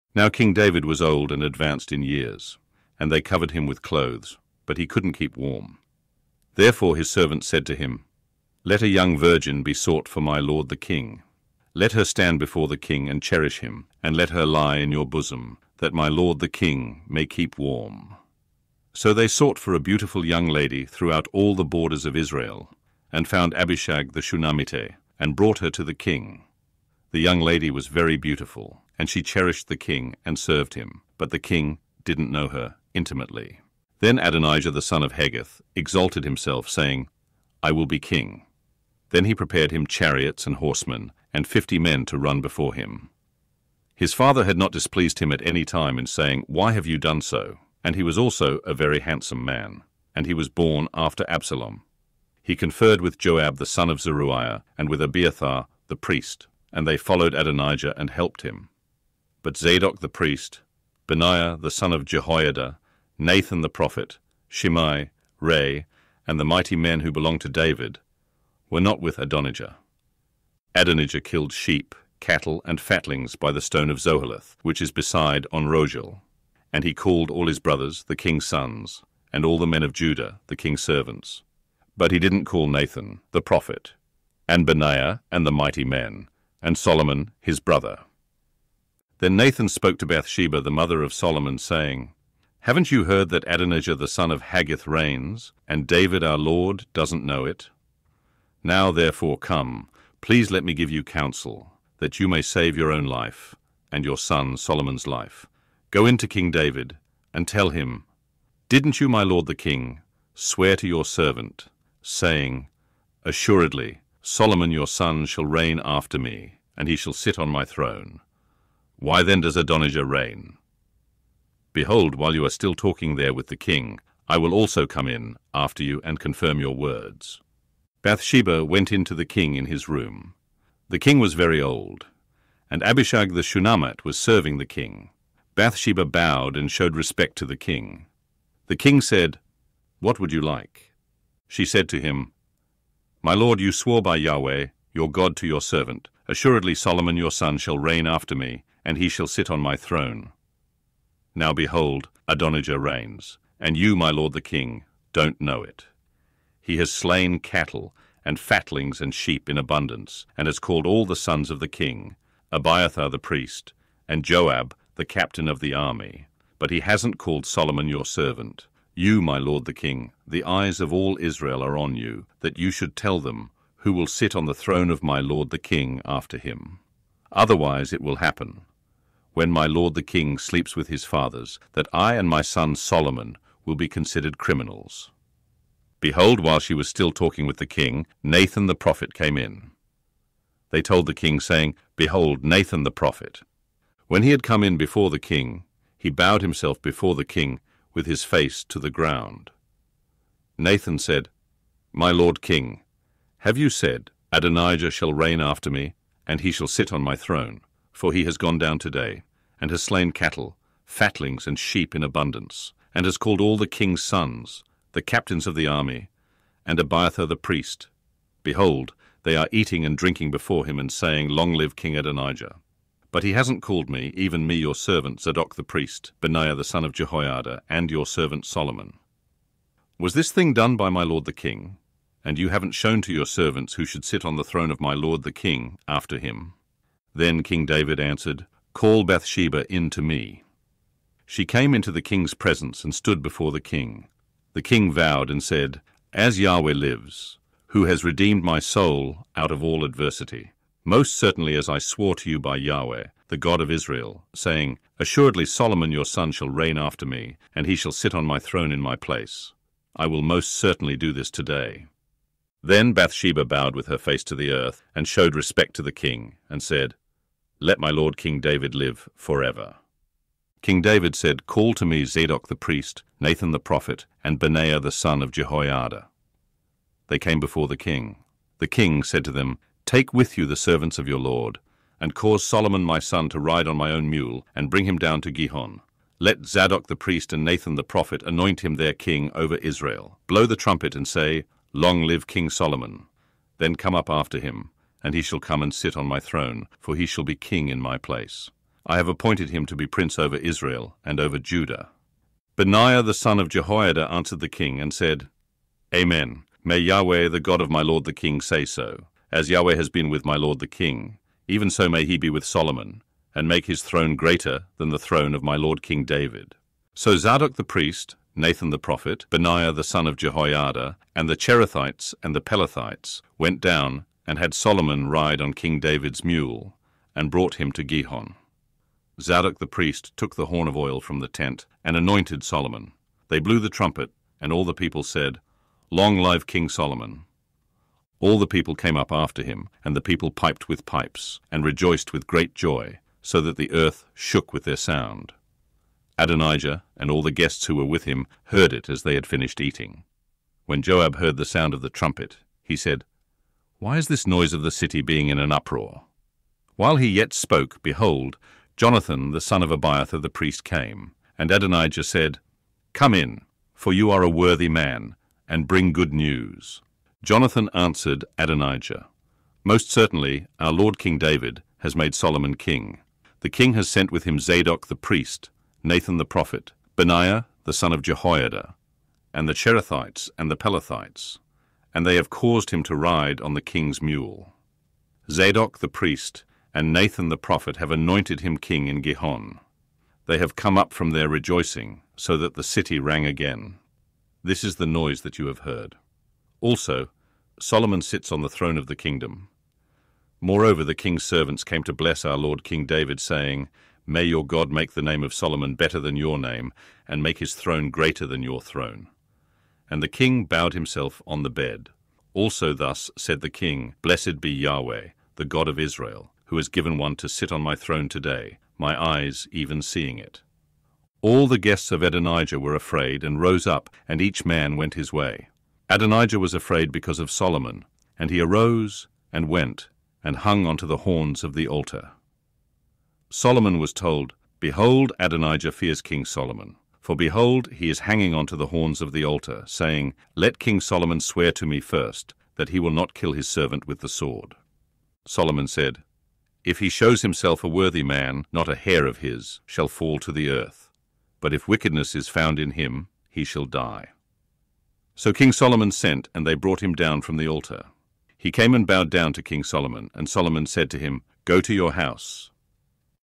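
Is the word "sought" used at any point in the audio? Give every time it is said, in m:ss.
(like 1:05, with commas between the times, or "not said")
0:09, 0:19.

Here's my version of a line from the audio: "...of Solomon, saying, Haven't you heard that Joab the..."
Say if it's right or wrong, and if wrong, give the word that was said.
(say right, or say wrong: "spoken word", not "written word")
wrong: "Adonijah", not "Joab".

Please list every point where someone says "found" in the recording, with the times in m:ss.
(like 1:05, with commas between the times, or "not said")
0:23, 7:32.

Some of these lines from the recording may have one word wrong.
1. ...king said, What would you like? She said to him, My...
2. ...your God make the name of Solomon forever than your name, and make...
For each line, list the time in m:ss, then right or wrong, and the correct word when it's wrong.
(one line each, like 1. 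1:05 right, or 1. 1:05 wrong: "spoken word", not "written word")
1. 2:18 right
2. 6:44 wrong: "better", not "forever".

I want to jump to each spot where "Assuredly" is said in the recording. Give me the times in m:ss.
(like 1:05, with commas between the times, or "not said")
1:53, 2:26, 4:14.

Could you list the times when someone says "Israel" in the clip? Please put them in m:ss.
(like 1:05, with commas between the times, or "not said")
0:22, 2:51, 4:13, 4:49, 5:00, 6:55.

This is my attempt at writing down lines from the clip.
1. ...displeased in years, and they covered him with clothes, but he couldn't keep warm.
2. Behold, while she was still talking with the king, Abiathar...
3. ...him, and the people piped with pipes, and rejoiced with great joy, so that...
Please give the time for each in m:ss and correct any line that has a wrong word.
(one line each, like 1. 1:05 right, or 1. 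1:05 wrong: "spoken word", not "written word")
1. 0:01 wrong: "advanced", not "displeased"
2. 3:06 wrong: "Nathan", not "Abiathar"
3. 5:39 right.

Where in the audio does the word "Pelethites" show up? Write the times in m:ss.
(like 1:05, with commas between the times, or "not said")
5:22, 6:20.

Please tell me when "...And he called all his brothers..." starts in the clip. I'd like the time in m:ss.
1:16.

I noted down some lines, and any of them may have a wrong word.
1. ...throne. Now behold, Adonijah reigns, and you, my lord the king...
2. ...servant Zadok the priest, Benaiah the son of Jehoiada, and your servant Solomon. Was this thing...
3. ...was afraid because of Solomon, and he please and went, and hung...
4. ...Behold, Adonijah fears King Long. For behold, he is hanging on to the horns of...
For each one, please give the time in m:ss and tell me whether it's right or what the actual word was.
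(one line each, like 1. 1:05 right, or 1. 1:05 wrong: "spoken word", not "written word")
1. 2:29 right
2. 3:44 right
3. 7:06 wrong: "arose", not "please"
4. 7:14 wrong: "Solomon", not "Long".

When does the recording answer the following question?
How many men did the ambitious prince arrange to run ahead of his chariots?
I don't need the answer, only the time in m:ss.
0:41.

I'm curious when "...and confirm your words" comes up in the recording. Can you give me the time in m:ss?
2:06.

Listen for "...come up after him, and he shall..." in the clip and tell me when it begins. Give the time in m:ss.
4:53.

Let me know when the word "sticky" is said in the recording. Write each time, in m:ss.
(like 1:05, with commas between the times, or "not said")
not said.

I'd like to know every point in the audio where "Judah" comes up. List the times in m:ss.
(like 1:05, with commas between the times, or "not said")
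1:19, 5:01.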